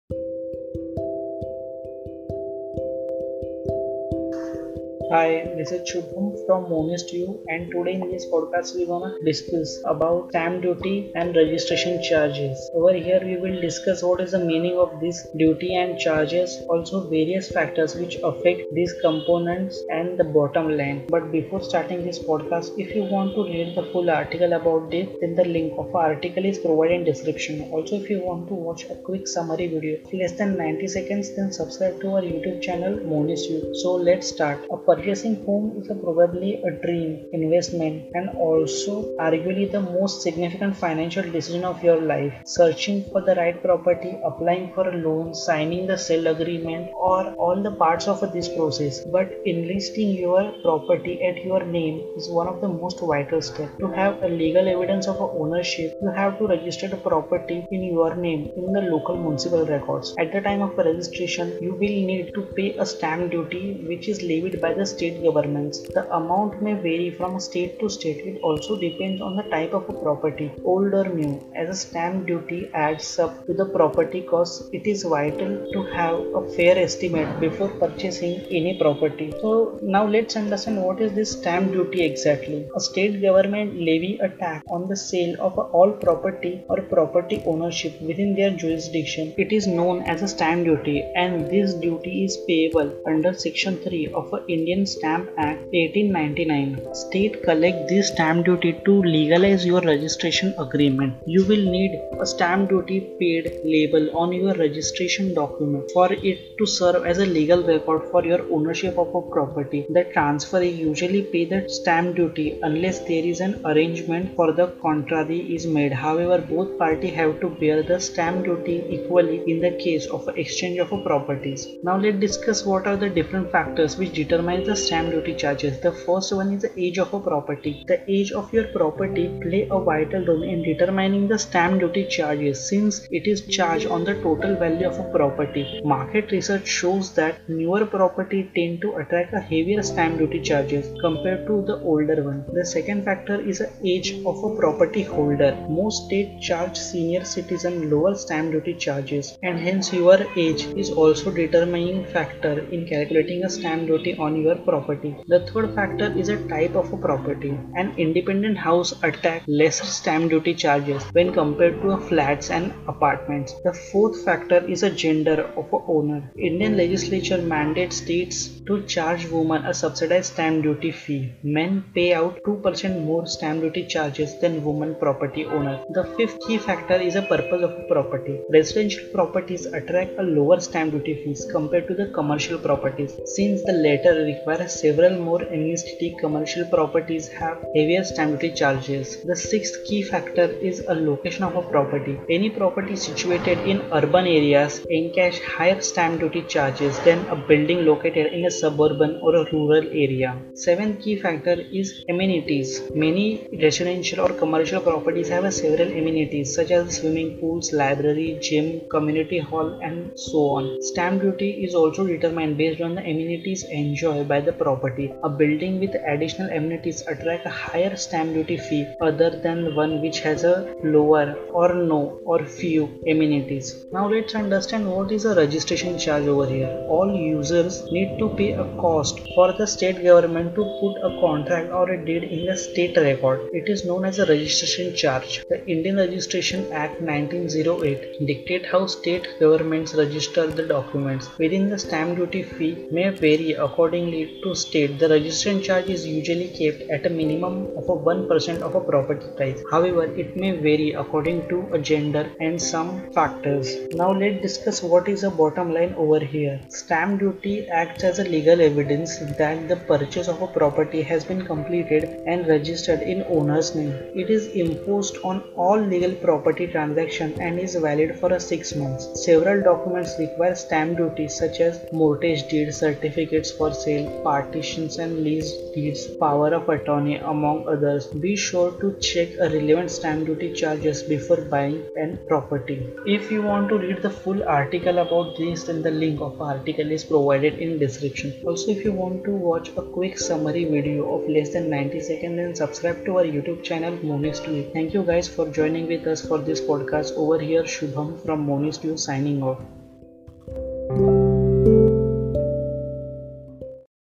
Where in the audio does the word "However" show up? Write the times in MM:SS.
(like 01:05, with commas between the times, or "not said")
01:56, 04:09.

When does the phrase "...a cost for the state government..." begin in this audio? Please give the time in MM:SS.
03:48.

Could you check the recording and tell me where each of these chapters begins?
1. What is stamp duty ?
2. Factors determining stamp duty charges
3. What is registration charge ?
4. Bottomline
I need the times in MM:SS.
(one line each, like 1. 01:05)
1. 01:20
2. 02:00
3. 03:44
4. 04:15.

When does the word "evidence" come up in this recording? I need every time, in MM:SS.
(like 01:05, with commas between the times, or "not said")
00:54, 04:18.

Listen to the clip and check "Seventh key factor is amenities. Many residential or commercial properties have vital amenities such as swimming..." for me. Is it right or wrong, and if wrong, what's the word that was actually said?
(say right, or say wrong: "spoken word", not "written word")
wrong: "several", not "vital".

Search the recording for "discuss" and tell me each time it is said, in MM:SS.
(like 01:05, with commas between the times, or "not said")
00:09, 00:13, 02:02, 04:14.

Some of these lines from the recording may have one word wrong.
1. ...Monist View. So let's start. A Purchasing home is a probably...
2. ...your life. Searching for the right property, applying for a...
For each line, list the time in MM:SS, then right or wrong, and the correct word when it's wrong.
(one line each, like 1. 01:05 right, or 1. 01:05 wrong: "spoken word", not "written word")
1. 00:33 right
2. 00:41 right.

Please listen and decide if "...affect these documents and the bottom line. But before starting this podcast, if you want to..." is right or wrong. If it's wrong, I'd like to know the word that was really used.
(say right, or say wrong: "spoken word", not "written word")
wrong: "components", not "documents".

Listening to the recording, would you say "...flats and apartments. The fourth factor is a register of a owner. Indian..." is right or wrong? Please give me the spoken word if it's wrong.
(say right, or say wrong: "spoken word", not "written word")
wrong: "gender", not "register".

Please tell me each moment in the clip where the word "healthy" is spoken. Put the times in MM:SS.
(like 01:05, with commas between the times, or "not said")
not said.